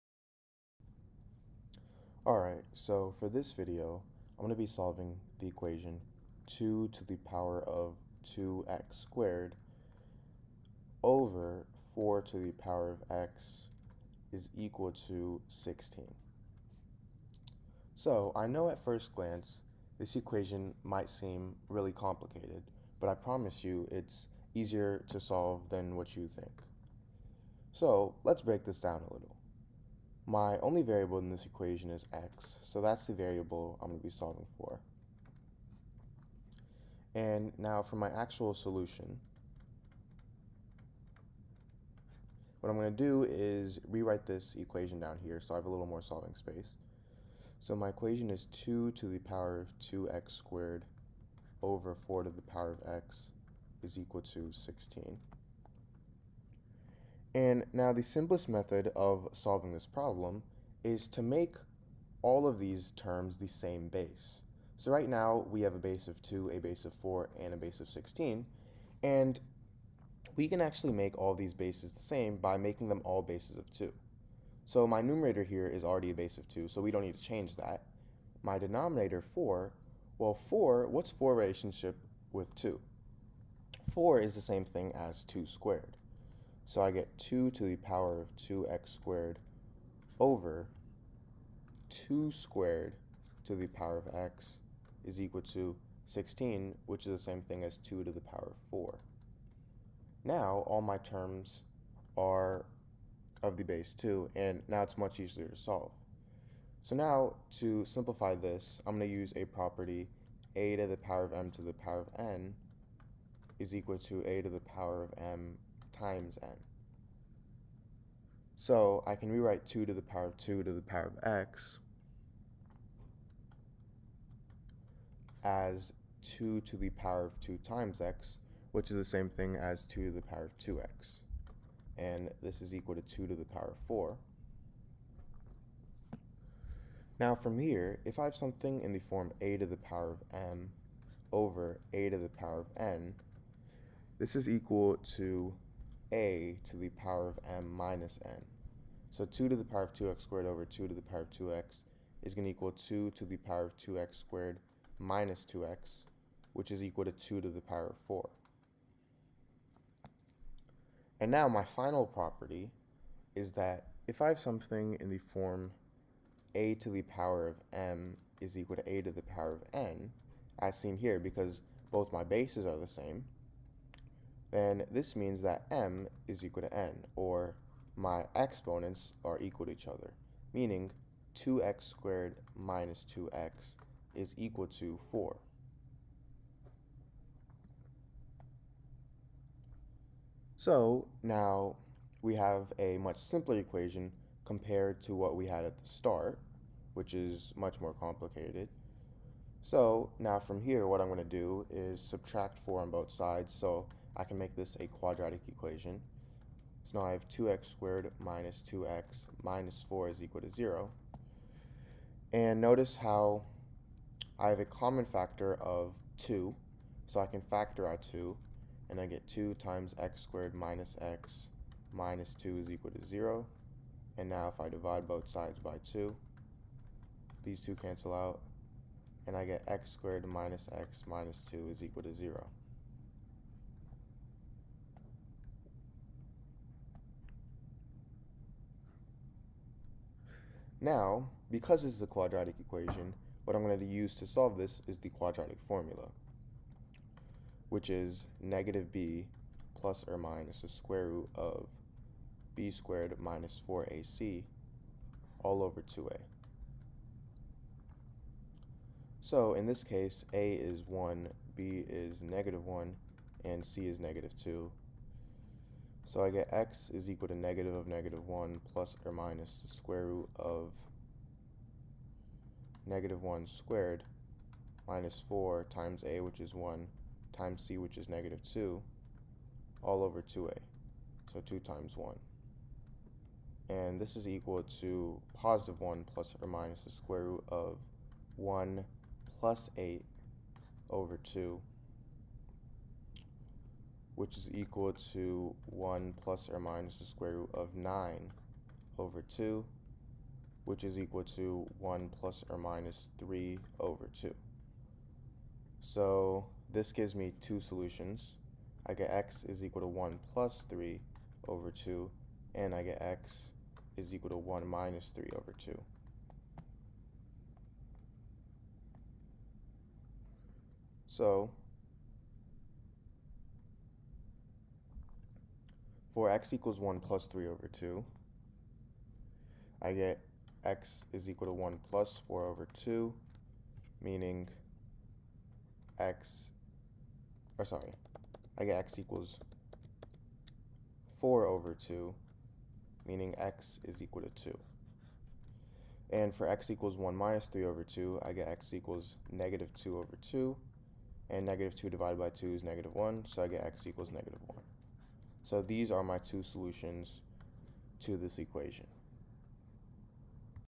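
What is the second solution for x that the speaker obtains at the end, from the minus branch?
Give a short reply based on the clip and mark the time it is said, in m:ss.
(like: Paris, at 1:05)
-1, at 5:53.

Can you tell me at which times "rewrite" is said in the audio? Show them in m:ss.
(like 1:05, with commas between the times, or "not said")
0:43, 1:59.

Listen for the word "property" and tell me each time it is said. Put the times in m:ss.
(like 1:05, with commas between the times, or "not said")
1:49, 2:42.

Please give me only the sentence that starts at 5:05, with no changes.
So this gives me two solutions.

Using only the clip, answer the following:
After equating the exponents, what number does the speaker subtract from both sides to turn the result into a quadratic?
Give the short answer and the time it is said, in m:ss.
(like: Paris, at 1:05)
4, at 3:22.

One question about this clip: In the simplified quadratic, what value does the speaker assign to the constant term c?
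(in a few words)
-2.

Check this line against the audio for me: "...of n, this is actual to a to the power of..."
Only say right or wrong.
wrong.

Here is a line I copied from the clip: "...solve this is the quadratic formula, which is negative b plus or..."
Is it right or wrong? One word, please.
right.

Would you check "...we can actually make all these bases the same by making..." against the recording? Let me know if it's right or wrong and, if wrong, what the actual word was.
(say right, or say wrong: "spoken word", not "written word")
right.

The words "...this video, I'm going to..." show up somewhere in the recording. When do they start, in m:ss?
0:03.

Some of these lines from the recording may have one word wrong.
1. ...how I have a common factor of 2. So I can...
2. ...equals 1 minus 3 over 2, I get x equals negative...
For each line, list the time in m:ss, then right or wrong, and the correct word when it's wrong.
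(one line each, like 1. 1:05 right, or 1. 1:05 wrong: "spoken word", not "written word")
1. 3:32 right
2. 5:46 right.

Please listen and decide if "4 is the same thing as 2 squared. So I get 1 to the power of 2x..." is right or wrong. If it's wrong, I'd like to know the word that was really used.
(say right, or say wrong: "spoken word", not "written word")
wrong: "2", not "1".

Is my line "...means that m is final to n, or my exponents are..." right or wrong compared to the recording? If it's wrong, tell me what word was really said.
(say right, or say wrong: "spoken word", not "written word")
wrong: "equal", not "final".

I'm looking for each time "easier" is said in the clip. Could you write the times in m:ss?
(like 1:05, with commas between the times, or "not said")
0:24, 1:45.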